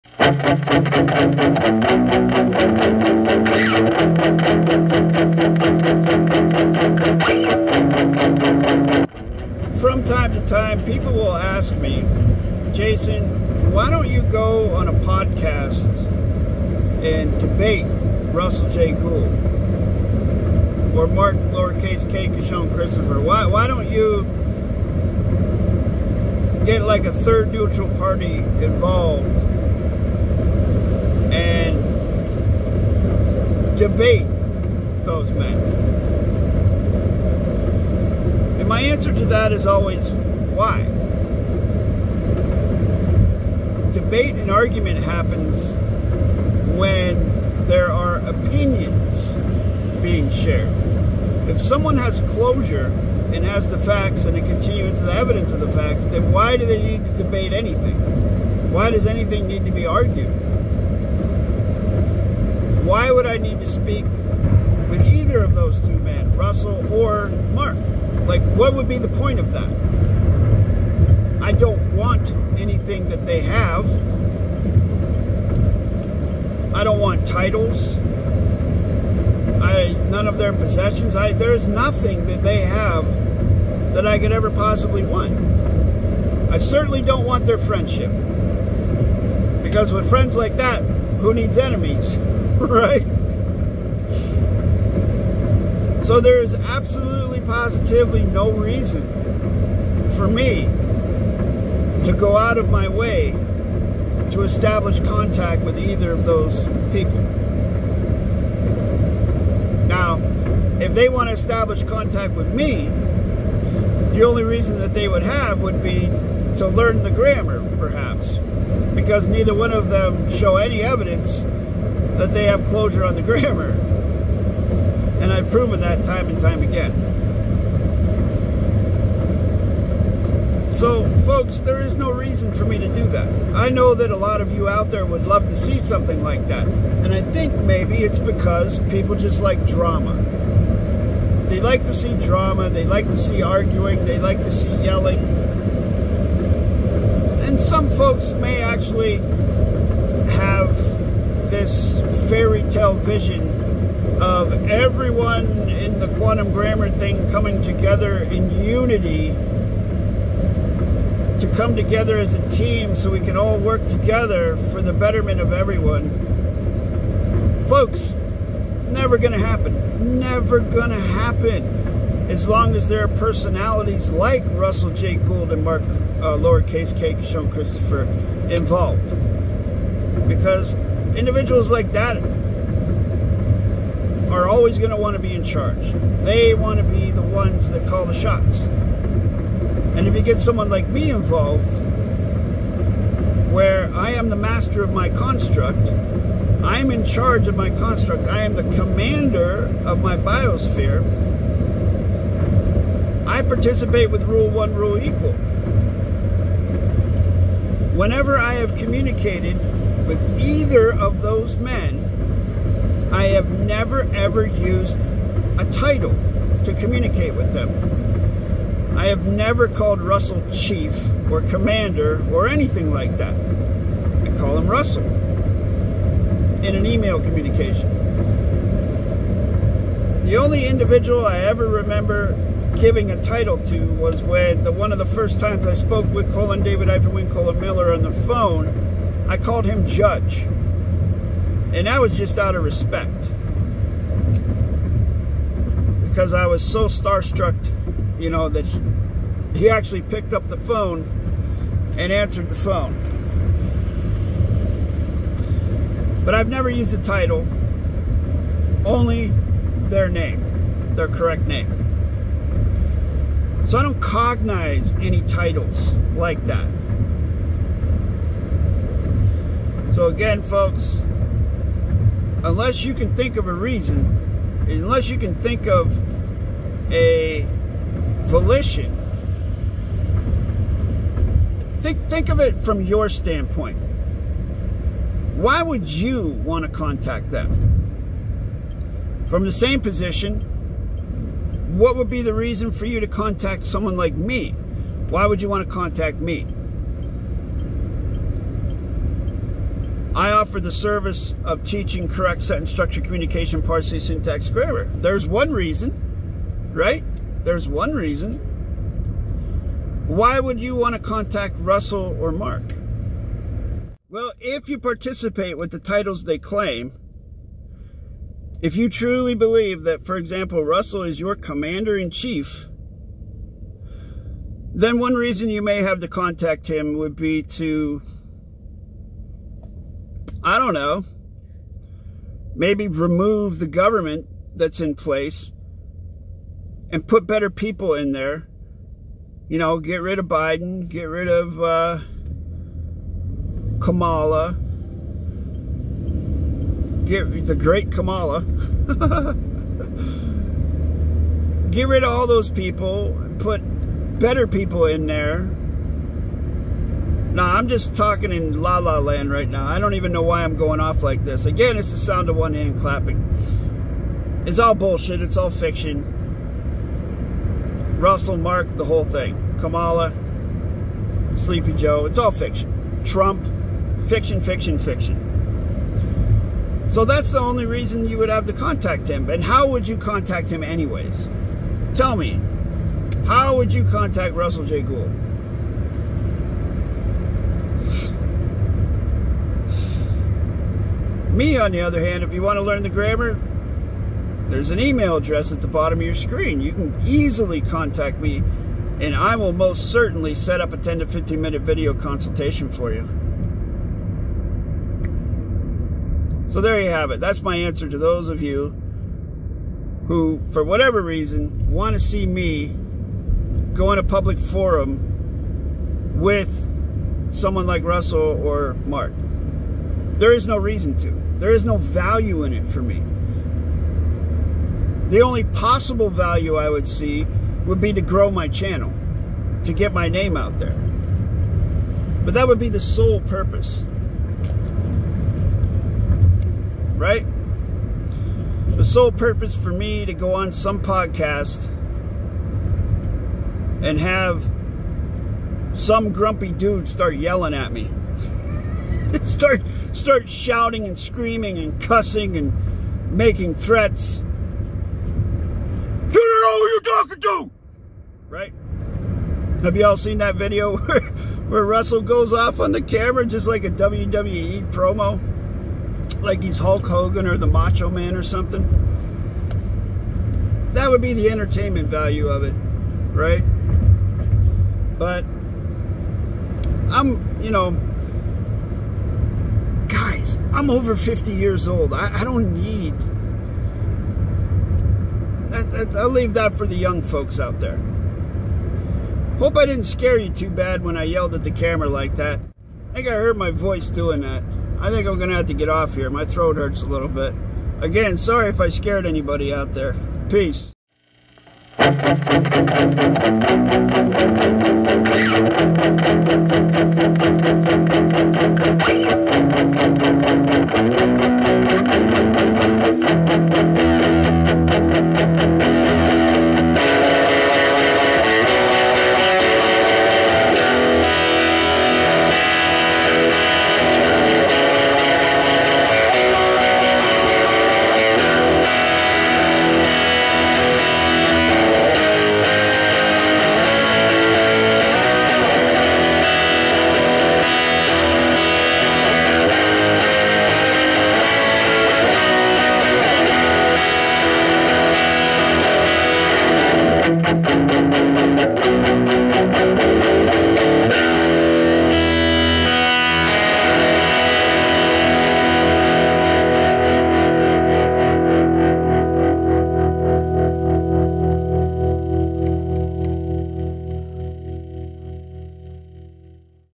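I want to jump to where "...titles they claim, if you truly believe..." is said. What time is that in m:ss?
5:15.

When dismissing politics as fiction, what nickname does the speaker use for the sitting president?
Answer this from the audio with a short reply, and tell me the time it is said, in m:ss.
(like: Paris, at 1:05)
Sleepy Joe, at 6:11.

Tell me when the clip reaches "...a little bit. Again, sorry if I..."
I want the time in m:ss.
8:16.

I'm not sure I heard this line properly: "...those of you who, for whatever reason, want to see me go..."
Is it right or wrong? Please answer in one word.
right.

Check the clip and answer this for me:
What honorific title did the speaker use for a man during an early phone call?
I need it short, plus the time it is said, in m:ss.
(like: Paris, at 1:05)
judge, at 3:59.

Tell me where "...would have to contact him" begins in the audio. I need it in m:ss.
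6:18.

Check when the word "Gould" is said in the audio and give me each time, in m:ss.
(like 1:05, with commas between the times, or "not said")
0:18, 2:55, 6:24.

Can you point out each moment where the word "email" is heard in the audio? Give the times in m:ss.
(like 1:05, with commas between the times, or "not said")
3:46, 6:34.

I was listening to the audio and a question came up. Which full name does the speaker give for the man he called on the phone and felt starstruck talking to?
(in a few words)
Colin Miller.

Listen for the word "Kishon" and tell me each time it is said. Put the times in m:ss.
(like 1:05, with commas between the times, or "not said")
0:22.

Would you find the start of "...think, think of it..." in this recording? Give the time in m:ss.
4:41.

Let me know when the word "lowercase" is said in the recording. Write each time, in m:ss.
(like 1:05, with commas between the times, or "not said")
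0:21, 2:56.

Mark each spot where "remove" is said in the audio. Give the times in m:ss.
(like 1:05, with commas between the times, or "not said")
5:32.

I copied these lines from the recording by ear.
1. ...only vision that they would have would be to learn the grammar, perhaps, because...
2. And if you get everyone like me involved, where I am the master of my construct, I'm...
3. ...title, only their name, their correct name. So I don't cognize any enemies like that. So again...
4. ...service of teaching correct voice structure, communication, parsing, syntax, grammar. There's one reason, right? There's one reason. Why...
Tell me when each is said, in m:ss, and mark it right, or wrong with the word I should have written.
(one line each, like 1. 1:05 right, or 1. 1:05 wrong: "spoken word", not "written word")
1. 1:54 wrong: "reason", not "vision"
2. 3:09 wrong: "someone", not "everyone"
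3. 4:17 wrong: "titles", not "enemies"
4. 5:00 wrong: "sentence", not "voice".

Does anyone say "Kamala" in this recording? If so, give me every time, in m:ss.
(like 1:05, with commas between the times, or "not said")
5:43, 5:47, 6:09.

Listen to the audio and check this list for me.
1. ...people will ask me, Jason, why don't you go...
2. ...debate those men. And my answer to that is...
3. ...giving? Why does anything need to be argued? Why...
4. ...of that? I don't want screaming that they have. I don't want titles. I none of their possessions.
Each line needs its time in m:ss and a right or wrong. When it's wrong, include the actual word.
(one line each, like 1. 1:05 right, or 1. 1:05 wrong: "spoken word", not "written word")
1. 0:10 right
2. 0:33 right
3. 0:57 wrong: "anything", not "giving"
4. 1:09 wrong: "anything", not "screaming".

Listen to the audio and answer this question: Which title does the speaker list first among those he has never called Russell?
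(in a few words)
chief.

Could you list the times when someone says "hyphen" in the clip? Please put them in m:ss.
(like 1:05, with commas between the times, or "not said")
3:56.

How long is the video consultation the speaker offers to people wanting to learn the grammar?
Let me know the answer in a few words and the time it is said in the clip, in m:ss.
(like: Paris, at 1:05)
10 to 15 minutes, at 6:40.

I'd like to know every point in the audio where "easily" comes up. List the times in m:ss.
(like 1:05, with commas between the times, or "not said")
6:37.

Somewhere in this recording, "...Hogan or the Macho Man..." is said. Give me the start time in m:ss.
7:46.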